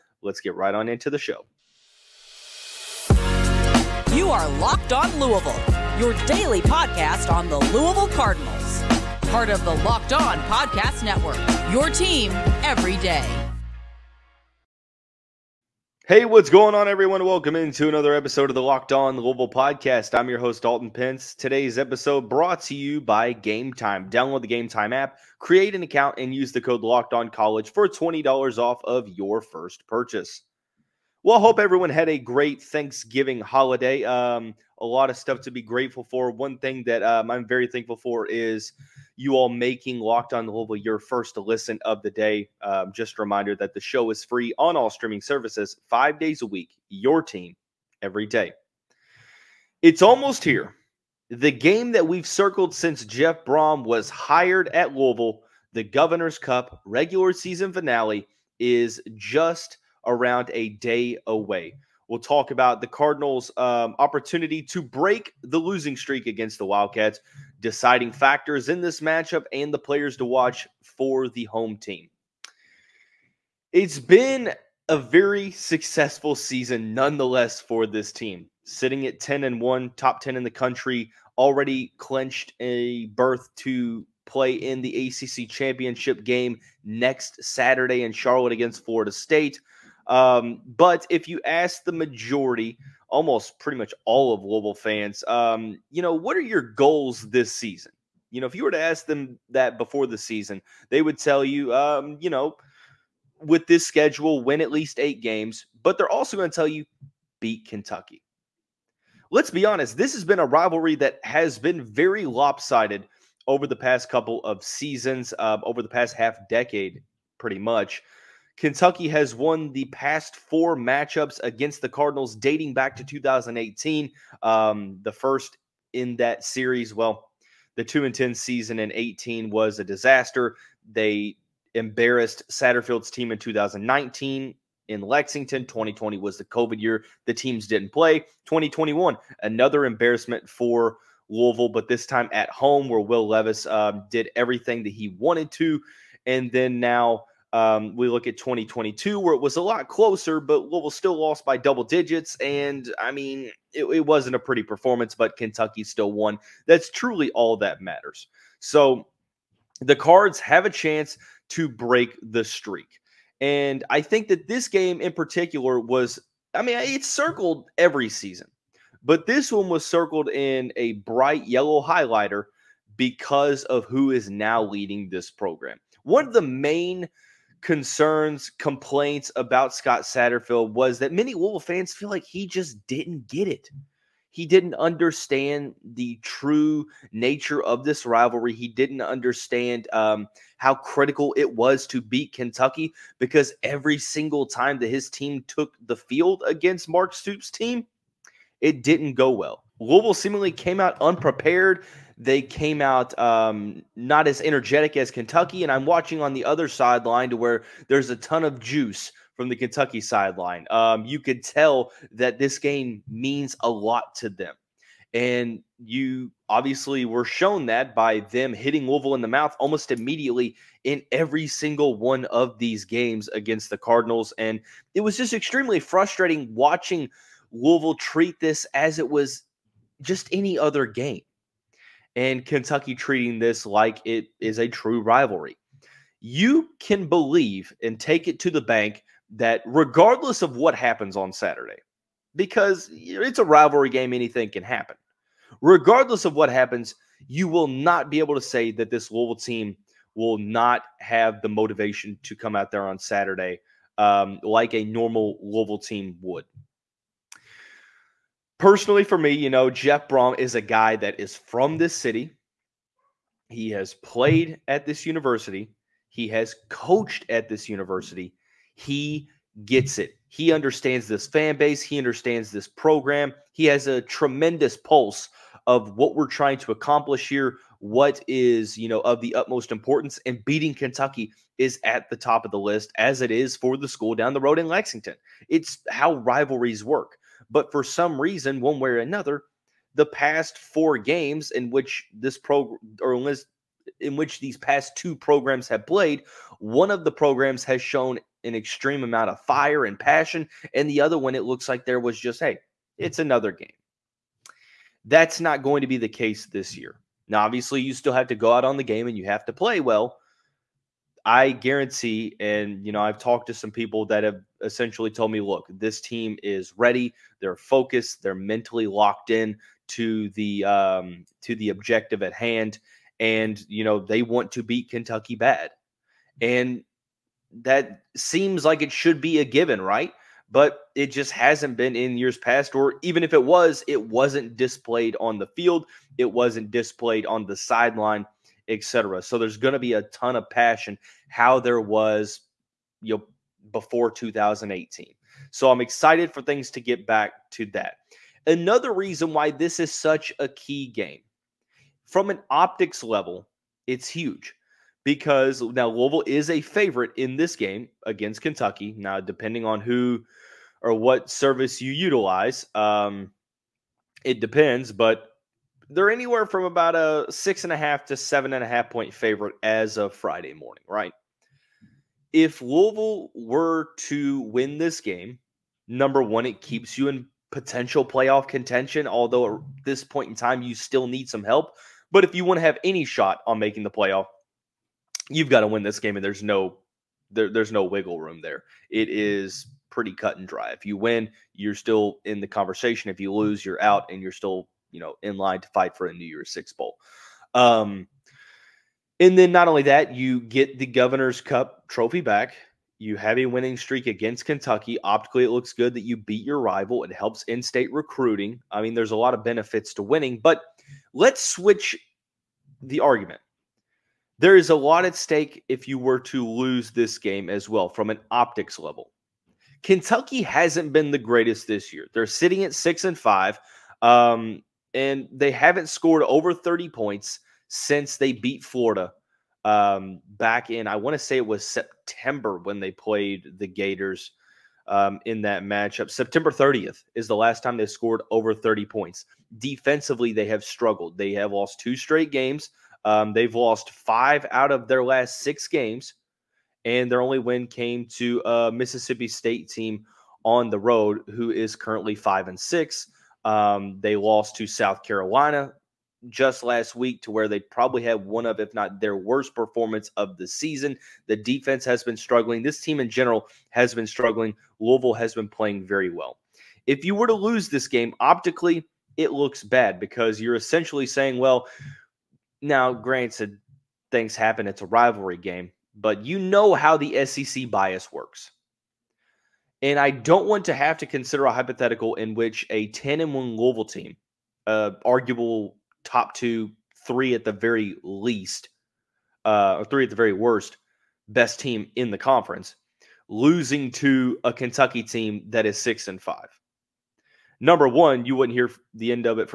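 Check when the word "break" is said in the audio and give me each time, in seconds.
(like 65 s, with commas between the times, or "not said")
64 s, 161 s.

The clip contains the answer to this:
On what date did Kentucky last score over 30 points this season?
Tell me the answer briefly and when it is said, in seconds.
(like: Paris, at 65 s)
September 30th, at 436 s.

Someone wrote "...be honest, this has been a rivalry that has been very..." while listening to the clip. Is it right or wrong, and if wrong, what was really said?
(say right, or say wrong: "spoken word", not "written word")
right.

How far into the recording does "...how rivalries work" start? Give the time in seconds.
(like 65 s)
285 s.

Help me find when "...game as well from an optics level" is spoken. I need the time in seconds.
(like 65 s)
417 s.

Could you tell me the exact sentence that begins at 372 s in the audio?
if Louisville were to win this game, number one, it mm-hmm.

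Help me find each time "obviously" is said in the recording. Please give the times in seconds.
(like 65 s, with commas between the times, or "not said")
216 s, 307 s.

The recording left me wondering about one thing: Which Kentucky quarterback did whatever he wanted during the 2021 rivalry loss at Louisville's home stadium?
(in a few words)
Will Levis.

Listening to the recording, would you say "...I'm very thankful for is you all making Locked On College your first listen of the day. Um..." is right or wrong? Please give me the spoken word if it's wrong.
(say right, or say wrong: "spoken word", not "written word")
wrong: "Louisville", not "College".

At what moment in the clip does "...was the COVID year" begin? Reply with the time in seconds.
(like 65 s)
136 s.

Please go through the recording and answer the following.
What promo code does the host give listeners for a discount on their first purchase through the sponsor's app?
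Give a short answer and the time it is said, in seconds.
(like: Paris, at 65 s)
Locked On College, at 26 s.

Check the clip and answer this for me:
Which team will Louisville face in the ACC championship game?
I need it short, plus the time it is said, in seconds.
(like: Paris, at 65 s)
Florida State, at 88 s.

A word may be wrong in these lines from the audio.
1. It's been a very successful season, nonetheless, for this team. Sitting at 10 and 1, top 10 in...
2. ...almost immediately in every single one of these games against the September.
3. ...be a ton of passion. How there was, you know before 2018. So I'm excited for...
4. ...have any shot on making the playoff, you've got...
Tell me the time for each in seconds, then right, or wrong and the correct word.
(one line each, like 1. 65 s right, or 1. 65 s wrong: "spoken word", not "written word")
1. 73 s right
2. 219 s wrong: "Cardinals", not "September"
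3. 339 s right
4. 382 s right.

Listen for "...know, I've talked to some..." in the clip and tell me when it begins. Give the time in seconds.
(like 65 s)
312 s.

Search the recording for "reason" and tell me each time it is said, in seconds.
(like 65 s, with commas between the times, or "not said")
288 s, 348 s.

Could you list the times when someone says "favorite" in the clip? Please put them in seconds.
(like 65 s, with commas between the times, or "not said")
356 s, 369 s.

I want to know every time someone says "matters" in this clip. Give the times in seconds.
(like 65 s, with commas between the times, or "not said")
157 s.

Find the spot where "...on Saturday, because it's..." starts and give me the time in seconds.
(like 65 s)
241 s.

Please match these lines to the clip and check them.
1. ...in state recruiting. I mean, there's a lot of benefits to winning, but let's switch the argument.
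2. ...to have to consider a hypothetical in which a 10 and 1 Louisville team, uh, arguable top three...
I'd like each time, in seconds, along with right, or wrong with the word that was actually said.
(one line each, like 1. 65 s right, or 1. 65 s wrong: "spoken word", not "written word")
1. 407 s right
2. 480 s wrong: "two", not "three".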